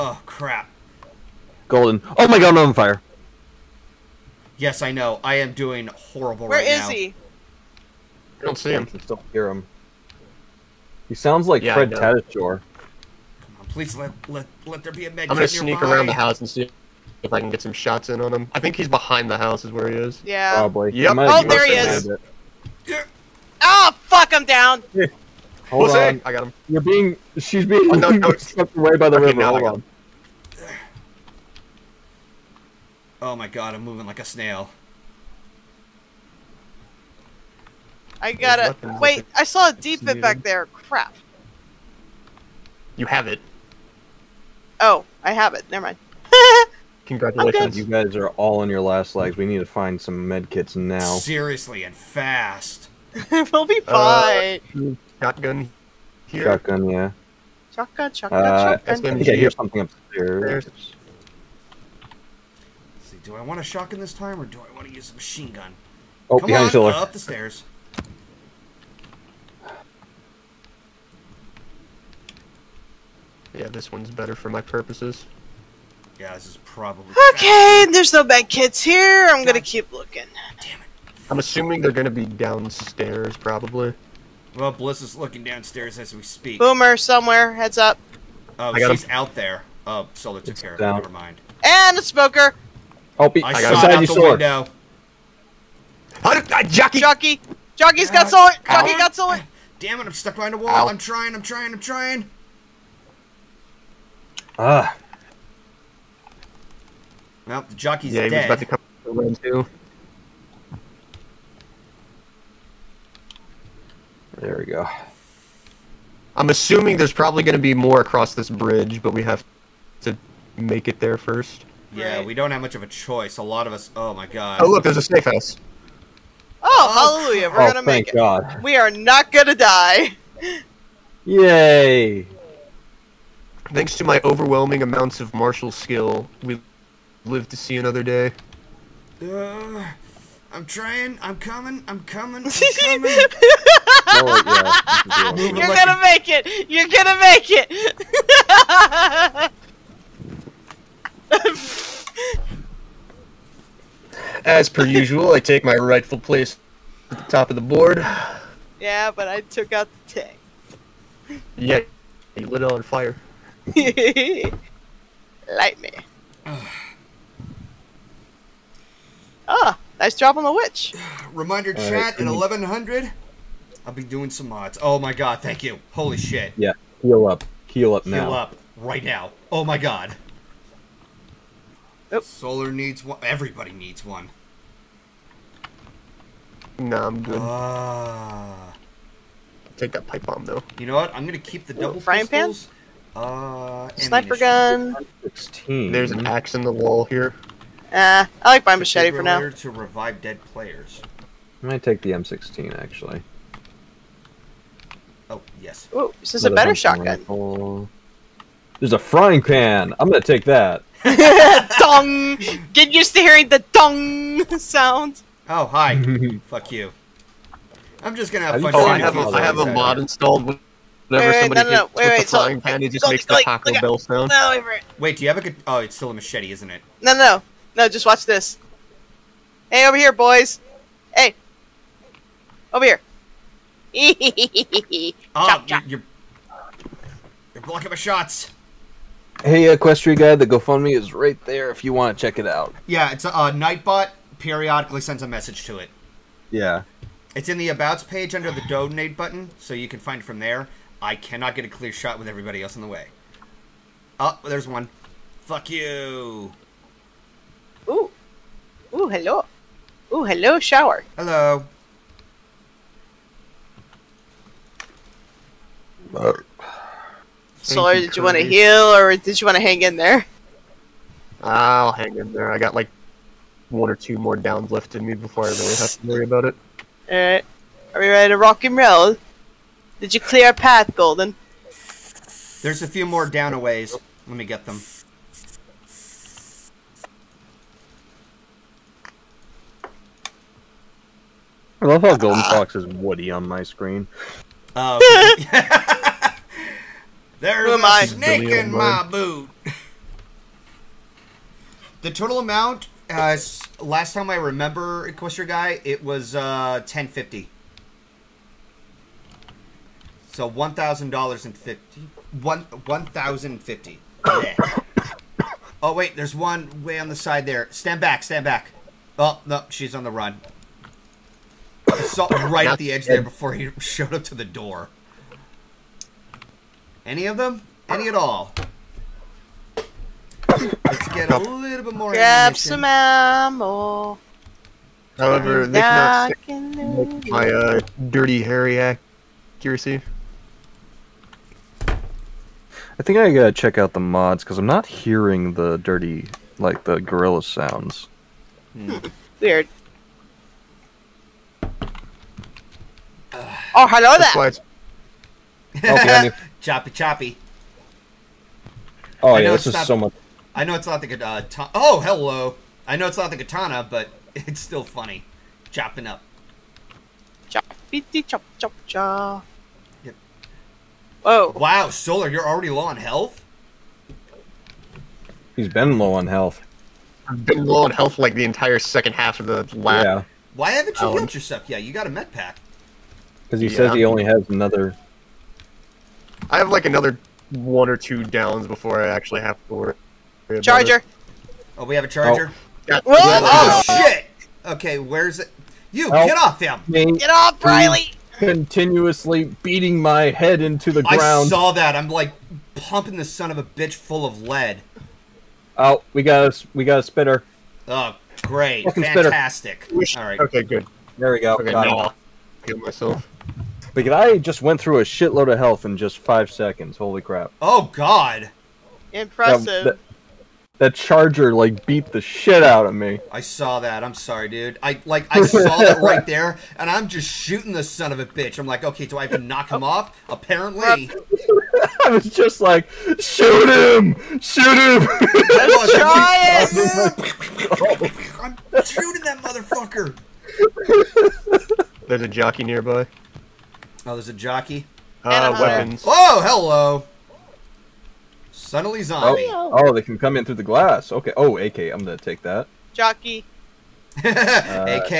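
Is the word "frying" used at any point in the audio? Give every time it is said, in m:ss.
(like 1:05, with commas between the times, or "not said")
3:11, 3:28.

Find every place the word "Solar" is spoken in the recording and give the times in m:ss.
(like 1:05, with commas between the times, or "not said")
1:30, 3:02, 4:27, 6:11.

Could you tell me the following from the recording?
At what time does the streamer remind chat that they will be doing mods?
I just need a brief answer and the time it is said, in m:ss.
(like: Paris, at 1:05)
1100, at 2:52.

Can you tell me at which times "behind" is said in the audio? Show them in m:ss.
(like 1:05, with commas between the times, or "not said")
0:18, 1:06, 1:40.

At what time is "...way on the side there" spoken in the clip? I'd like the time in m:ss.
5:16.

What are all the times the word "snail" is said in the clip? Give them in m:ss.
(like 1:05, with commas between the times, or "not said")
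0:34.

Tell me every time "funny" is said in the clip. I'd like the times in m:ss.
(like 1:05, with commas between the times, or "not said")
6:04.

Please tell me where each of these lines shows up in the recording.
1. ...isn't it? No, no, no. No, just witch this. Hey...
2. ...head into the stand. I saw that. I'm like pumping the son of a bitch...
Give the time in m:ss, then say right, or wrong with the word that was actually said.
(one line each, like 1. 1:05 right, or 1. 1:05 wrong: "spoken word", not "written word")
1. 3:46 wrong: "watch", not "witch"
2. 6:40 wrong: "ground", not "stand".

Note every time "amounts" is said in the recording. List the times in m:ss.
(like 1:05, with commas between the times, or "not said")
2:14, 5:02.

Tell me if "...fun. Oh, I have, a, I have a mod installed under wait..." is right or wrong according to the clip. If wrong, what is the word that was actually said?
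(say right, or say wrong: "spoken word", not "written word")
wrong: "whenever", not "under".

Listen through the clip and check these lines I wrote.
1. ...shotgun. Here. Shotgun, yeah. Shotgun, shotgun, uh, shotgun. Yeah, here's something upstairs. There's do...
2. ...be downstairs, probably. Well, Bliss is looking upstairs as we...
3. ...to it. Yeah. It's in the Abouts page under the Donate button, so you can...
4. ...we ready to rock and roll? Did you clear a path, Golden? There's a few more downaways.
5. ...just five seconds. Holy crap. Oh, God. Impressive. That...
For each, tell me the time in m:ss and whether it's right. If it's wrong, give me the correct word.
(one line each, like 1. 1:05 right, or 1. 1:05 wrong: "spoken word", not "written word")
1. 0:55 right
2. 1:22 wrong: "downstairs", not "upstairs"
3. 4:05 right
4. 4:38 right
5. 6:55 right.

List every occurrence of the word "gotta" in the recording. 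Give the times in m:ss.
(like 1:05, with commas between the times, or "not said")
0:38, 5:43.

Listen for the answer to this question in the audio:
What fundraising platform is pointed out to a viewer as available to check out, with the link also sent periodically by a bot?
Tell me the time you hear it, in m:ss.
4:00.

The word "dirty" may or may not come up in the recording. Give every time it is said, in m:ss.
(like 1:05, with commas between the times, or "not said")
5:38, 5:45.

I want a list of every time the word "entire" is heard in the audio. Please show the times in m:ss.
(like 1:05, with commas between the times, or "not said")
6:18.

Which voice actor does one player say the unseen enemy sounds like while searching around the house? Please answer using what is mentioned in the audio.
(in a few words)
Fred Tatasciore.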